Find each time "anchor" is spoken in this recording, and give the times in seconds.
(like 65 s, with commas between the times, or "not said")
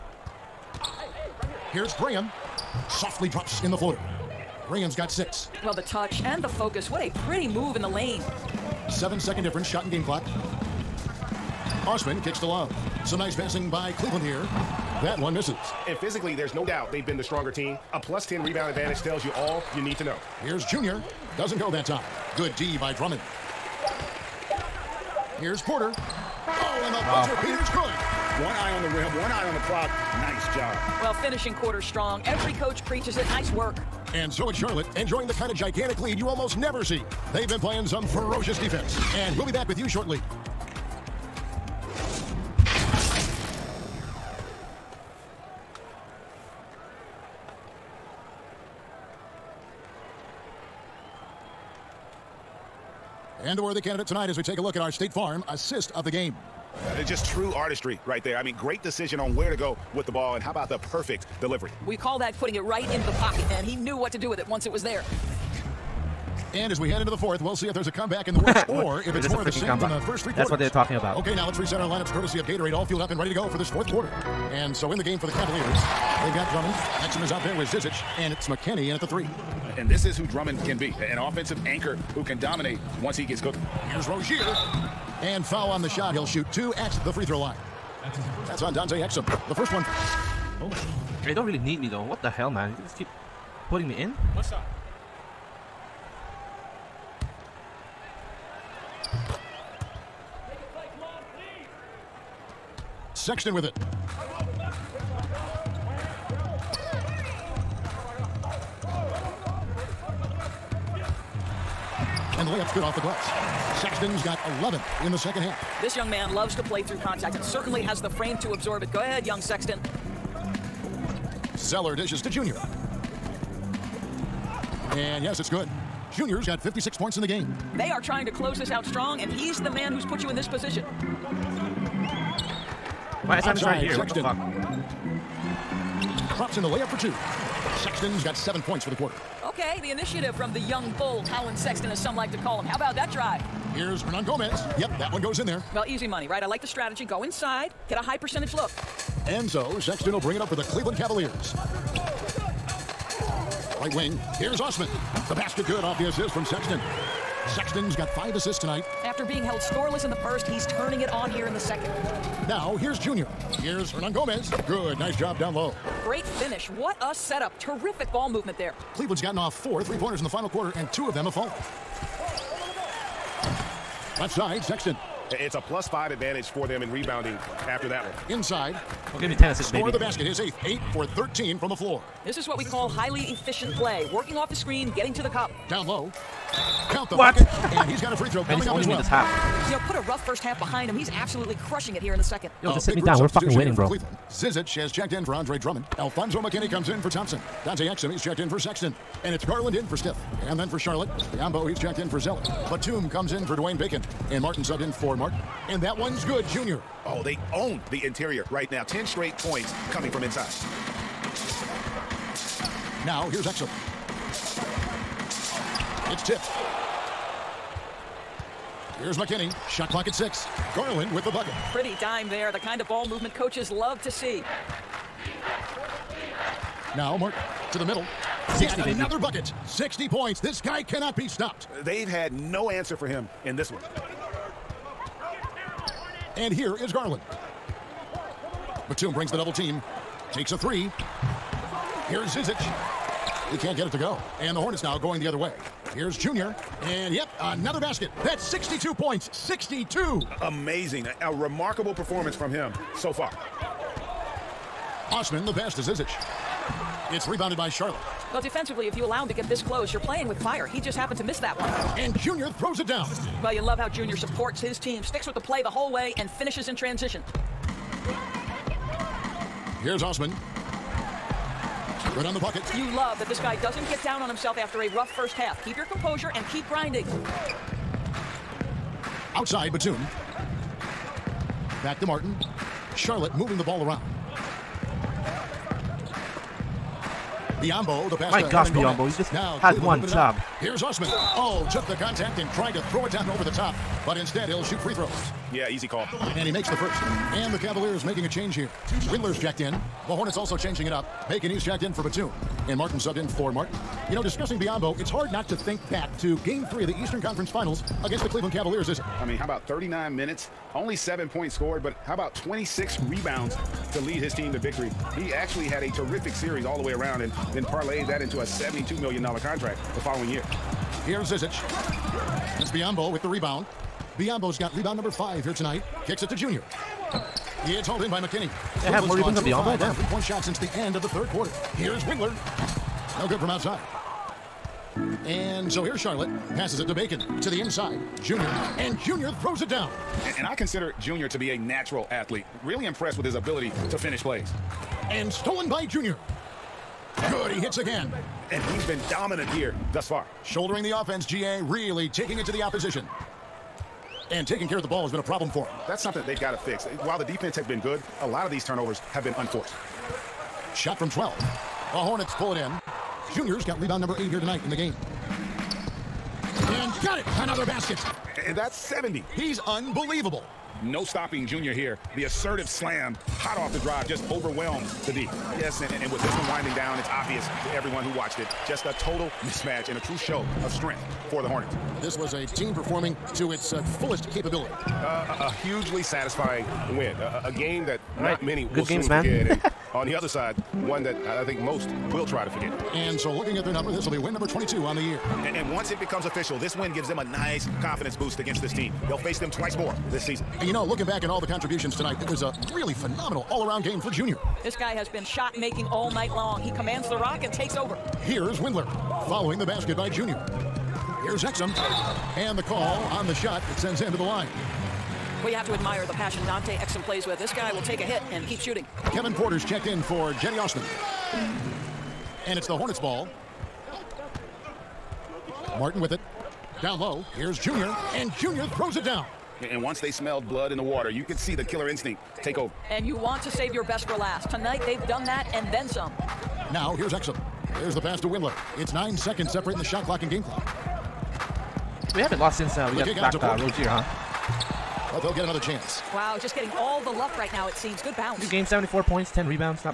81 s.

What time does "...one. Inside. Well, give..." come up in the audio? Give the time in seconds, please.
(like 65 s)
178 s.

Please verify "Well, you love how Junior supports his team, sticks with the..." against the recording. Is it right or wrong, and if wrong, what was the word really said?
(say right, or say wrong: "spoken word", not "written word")
right.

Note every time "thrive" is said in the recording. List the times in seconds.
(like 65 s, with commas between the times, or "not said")
not said.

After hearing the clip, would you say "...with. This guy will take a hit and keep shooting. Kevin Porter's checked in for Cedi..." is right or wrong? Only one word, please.
right.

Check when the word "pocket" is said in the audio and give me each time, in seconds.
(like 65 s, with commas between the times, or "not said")
63 s.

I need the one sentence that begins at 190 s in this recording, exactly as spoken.
He's absolutely crushing it here in the second.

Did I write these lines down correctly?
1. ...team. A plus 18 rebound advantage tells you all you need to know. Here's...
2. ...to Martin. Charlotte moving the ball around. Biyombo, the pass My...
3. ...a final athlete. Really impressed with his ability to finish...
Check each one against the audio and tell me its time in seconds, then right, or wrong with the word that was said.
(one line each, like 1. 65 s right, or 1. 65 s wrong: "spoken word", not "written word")
1. 17 s wrong: "10", not "18"
2. 281 s right
3. 341 s wrong: "natural", not "final".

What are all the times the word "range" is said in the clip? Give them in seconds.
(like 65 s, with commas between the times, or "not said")
not said.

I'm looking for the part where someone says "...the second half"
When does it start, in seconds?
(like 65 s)
115 s.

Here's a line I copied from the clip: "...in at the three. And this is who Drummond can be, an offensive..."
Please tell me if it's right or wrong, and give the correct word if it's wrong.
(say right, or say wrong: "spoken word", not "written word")
right.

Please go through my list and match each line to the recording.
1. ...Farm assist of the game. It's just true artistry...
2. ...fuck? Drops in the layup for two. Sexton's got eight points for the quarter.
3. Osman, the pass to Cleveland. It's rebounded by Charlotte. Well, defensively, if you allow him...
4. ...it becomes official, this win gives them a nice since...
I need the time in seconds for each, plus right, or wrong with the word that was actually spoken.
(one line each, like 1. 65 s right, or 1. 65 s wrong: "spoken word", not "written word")
1. 55 s right
2. 136 s wrong: "seven", not "eight"
3. 255 s wrong: "Zizic", not "Cleveland"
4. 395 s wrong: "confidence", not "since".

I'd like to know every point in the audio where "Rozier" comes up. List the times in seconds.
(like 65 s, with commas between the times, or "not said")
84 s, 443 s.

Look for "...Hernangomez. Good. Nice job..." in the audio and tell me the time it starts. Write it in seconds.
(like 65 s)
163 s.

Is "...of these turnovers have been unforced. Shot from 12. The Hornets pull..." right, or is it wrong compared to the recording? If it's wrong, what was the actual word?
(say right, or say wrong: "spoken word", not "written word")
right.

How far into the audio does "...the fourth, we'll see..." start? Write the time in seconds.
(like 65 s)
67 s.